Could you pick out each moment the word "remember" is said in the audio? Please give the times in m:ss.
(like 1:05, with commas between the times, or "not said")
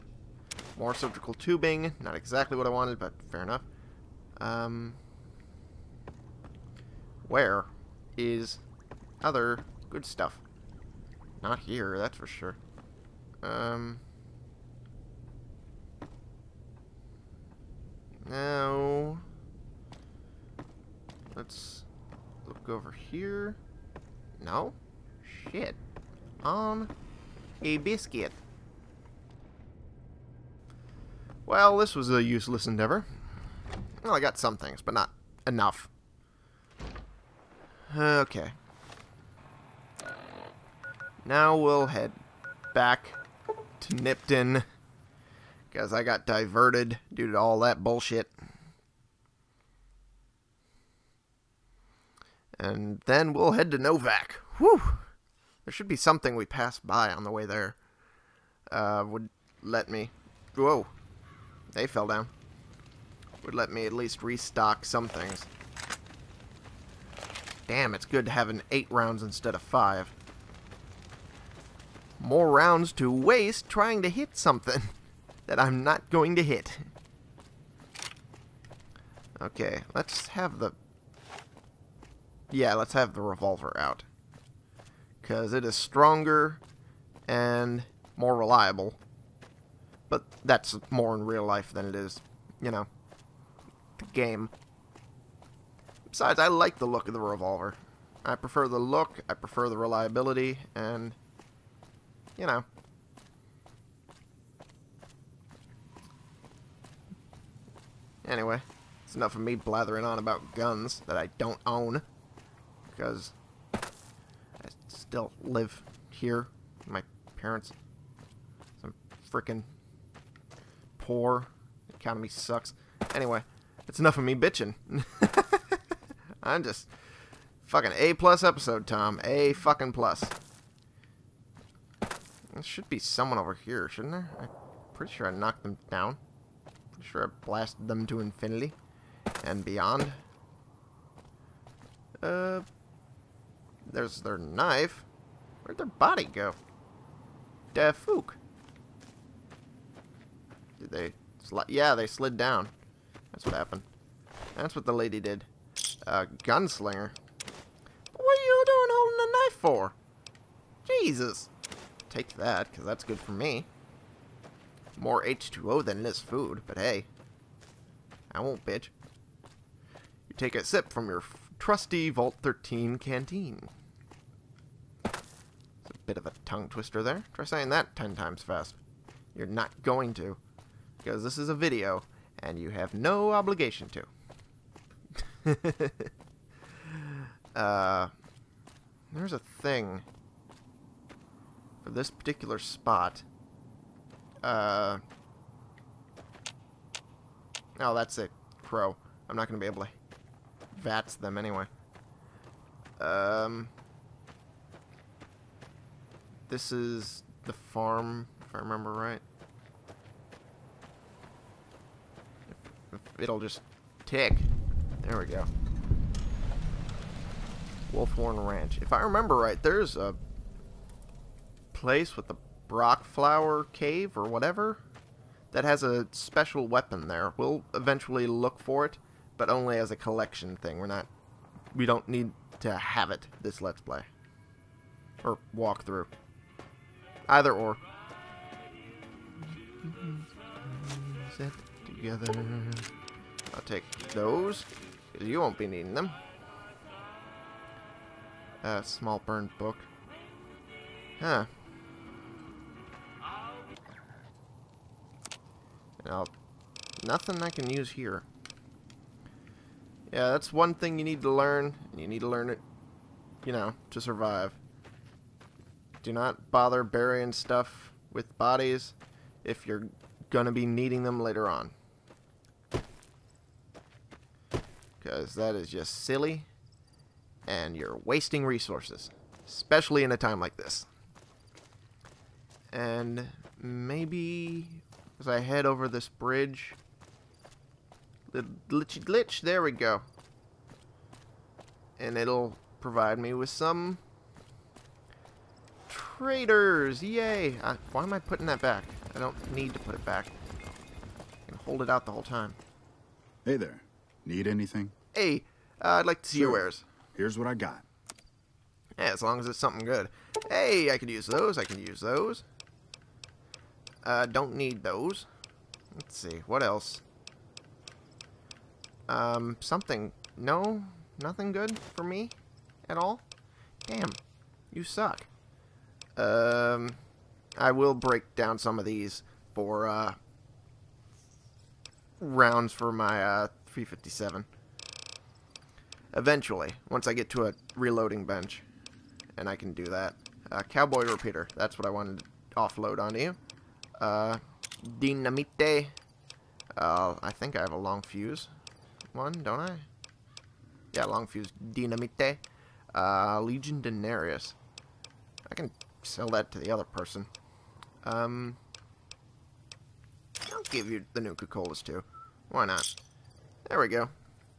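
3:28, 3:39.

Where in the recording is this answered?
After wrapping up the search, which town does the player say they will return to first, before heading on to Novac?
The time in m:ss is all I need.
0:43.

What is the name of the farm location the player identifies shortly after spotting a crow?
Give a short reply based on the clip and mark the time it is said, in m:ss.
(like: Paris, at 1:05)
Wolfhorn Ranch, at 3:37.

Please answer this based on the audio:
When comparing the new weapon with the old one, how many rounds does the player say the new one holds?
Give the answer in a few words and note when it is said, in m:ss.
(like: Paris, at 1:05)
8, at 1:08.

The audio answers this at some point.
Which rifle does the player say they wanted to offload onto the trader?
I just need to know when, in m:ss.
5:40.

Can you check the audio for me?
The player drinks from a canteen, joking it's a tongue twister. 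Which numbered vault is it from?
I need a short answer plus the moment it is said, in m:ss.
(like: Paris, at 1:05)
Vault 13, at 2:52.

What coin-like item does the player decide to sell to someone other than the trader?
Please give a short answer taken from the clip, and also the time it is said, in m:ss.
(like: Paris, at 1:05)
Legion Denarius, at 5:53.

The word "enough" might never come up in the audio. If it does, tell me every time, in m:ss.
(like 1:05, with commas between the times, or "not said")
0:03, 0:35, 1:49, 2:03.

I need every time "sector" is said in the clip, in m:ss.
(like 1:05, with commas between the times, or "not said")
not said.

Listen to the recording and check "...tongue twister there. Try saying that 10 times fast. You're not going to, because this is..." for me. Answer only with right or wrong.
right.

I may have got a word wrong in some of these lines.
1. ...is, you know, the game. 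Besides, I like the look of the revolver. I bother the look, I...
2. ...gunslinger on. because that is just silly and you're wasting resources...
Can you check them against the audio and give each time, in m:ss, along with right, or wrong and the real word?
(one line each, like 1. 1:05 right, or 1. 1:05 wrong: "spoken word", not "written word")
1. 1:31 wrong: "prefer", not "bother"
2. 4:31 wrong: "later", not "gunslinger".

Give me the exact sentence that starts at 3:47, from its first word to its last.
We'll eventually look for it, but only as a collection thing.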